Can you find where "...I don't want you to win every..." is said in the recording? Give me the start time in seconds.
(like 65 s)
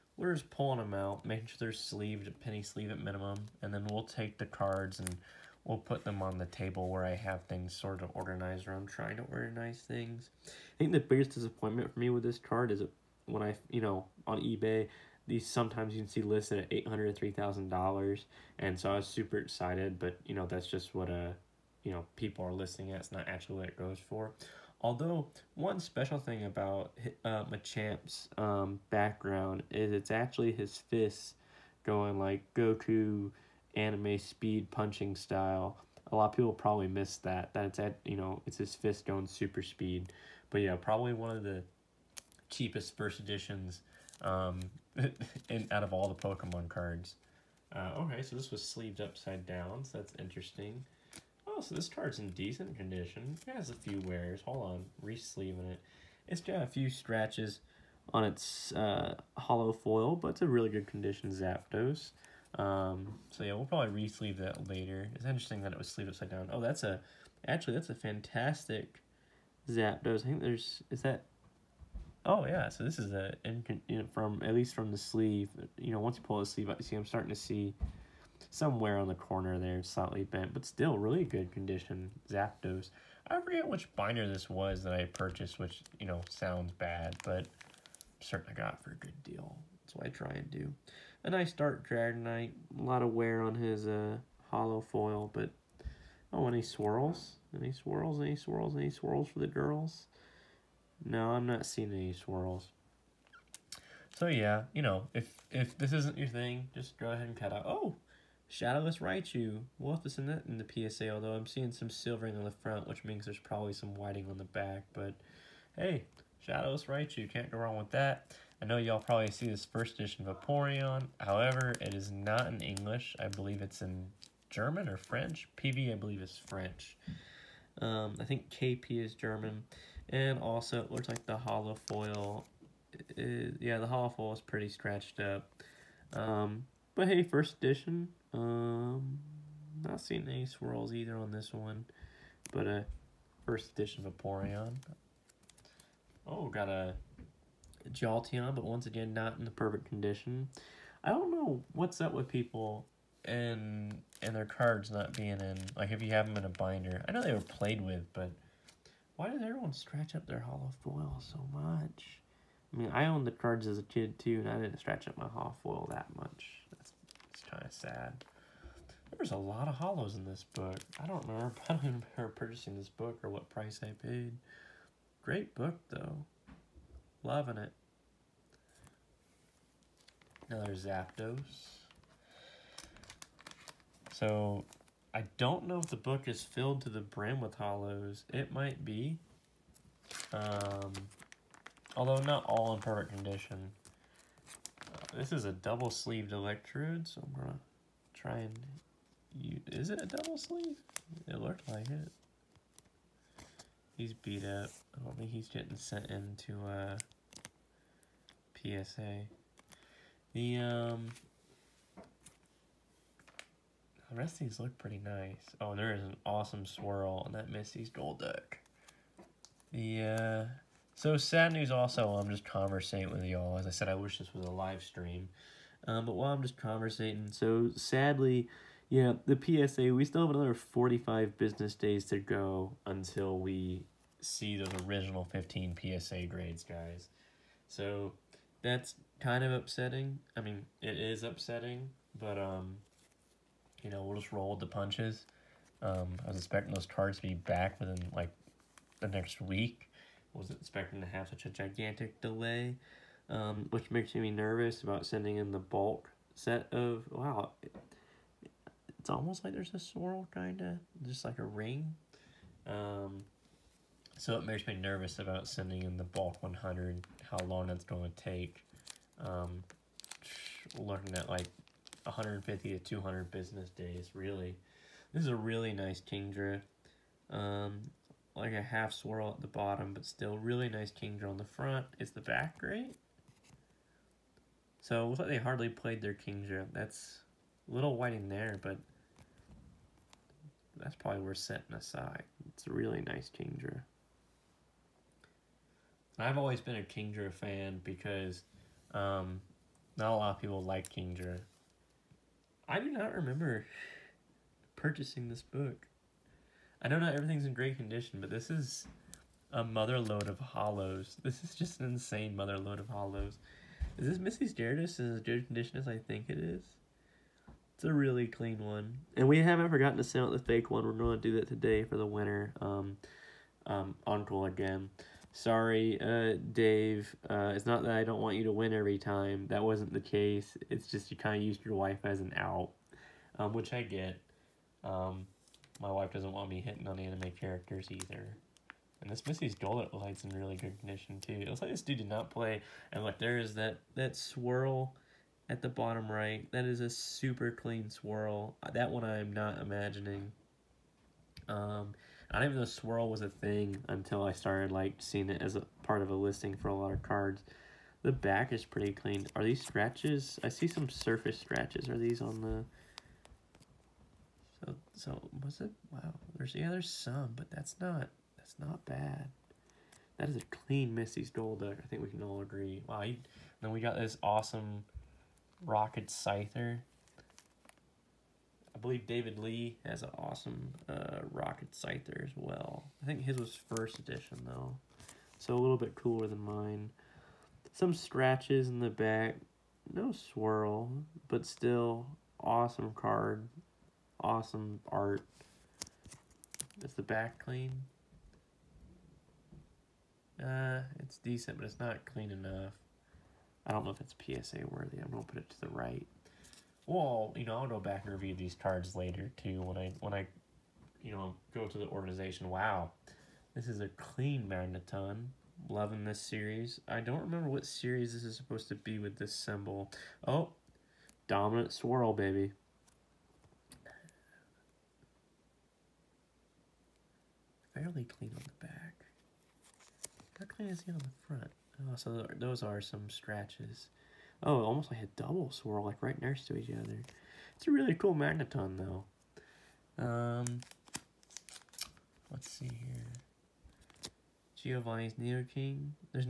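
327 s.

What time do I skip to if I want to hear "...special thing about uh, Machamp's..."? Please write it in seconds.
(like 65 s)
25 s.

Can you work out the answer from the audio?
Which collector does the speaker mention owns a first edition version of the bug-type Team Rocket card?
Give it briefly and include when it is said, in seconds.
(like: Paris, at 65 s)
David Lee, at 379 s.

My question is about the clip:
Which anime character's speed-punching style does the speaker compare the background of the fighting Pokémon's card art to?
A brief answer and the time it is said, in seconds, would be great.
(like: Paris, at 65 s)
Goku, at 32 s.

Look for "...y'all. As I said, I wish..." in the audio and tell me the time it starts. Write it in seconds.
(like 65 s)
223 s.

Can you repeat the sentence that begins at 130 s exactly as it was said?
And also, it looks like the hollow foil.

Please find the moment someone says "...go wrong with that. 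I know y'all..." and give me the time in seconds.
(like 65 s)
117 s.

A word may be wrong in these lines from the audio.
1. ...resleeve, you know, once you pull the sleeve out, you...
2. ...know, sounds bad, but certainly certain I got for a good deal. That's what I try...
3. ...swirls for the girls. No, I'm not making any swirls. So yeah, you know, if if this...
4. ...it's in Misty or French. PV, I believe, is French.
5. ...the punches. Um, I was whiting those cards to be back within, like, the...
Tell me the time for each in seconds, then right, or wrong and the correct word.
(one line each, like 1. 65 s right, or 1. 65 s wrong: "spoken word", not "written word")
1. 74 s wrong: "sleeve", not "resleeve"
2. 86 s right
3. 98 s wrong: "seeing", not "making"
4. 123 s wrong: "German", not "Misty"
5. 244 s wrong: "expecting", not "whiting".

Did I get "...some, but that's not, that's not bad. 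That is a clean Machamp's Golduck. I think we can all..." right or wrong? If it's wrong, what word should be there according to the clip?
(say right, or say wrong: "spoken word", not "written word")
wrong: "Missy", not "Machamp".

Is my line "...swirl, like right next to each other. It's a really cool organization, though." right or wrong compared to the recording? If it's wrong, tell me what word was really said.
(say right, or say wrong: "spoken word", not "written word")
wrong: "magneton", not "organization".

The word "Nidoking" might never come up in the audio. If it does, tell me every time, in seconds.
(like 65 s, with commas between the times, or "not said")
445 s.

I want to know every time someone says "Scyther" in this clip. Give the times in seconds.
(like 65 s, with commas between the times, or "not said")
376 s, 381 s.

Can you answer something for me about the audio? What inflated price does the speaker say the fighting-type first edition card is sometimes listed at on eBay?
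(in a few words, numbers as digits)
$803,000.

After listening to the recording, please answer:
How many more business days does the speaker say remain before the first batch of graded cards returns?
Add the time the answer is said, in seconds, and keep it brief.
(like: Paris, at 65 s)
45, at 230 s.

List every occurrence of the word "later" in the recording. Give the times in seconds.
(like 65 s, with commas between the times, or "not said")
64 s, 408 s.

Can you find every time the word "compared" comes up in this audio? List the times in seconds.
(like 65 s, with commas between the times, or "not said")
not said.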